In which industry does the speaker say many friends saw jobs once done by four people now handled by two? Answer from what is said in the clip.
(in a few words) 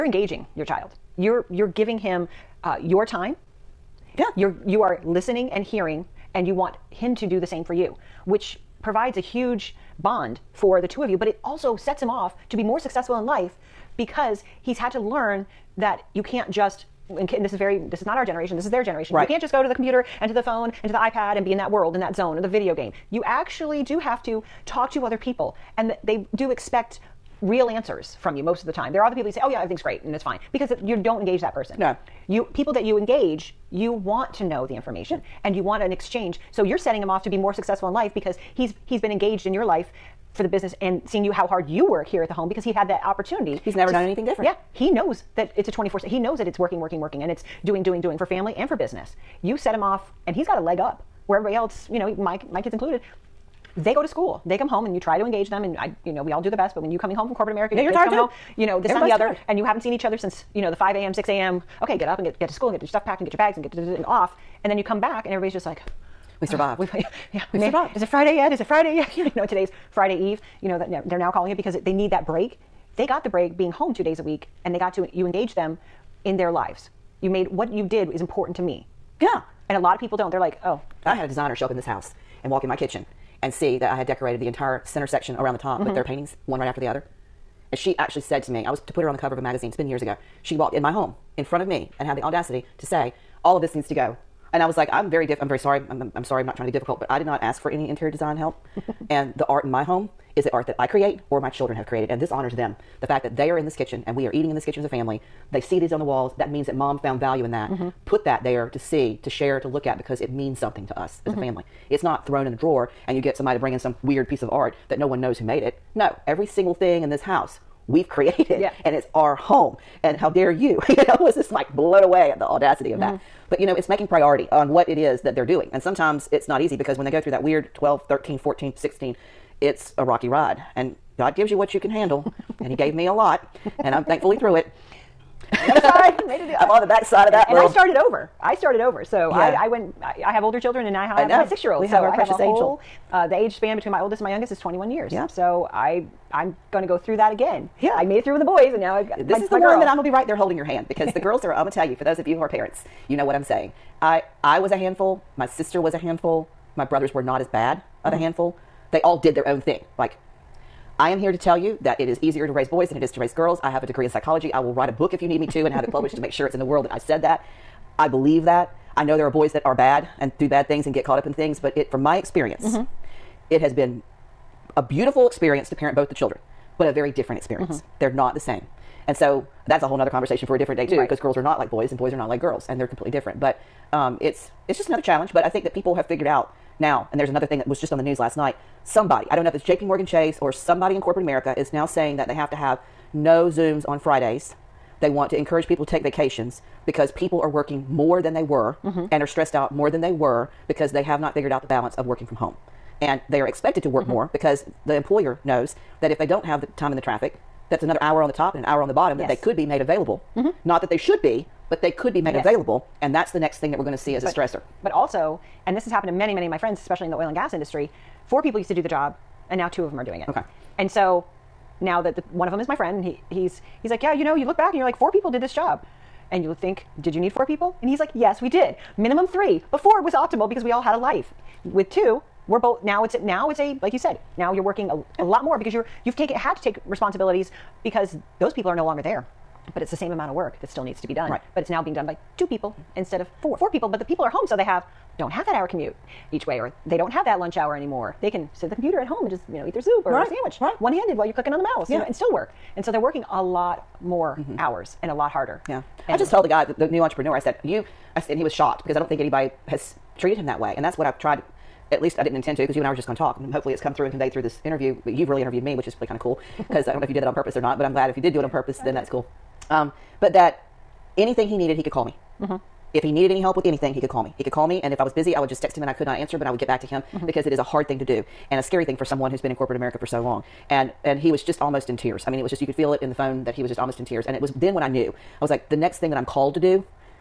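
oil and gas.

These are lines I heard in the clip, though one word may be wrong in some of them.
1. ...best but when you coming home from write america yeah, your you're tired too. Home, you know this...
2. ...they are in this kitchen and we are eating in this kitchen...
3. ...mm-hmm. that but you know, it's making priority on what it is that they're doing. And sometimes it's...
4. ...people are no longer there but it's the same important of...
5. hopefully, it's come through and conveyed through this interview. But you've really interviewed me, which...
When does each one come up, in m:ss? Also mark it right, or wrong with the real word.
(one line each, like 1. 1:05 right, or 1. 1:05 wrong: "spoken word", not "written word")
1. 0:56 wrong: "corporate", not "write"
2. 1:43 right
3. 2:02 right
4. 3:58 wrong: "amount", not "important"
5. 4:23 right.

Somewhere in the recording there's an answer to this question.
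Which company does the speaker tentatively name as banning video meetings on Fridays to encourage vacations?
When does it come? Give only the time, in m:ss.
3:09.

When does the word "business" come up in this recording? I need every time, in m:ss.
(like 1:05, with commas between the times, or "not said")
0:40, 0:48.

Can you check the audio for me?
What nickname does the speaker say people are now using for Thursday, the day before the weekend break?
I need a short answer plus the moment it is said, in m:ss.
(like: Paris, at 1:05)
Friday Eve, at 1:09.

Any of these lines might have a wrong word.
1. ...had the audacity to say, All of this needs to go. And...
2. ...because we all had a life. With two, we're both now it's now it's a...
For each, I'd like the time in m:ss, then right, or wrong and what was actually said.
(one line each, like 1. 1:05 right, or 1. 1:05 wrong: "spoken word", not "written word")
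1. 1:32 right
2. 3:50 right.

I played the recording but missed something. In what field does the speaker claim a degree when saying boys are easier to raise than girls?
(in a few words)
psychology.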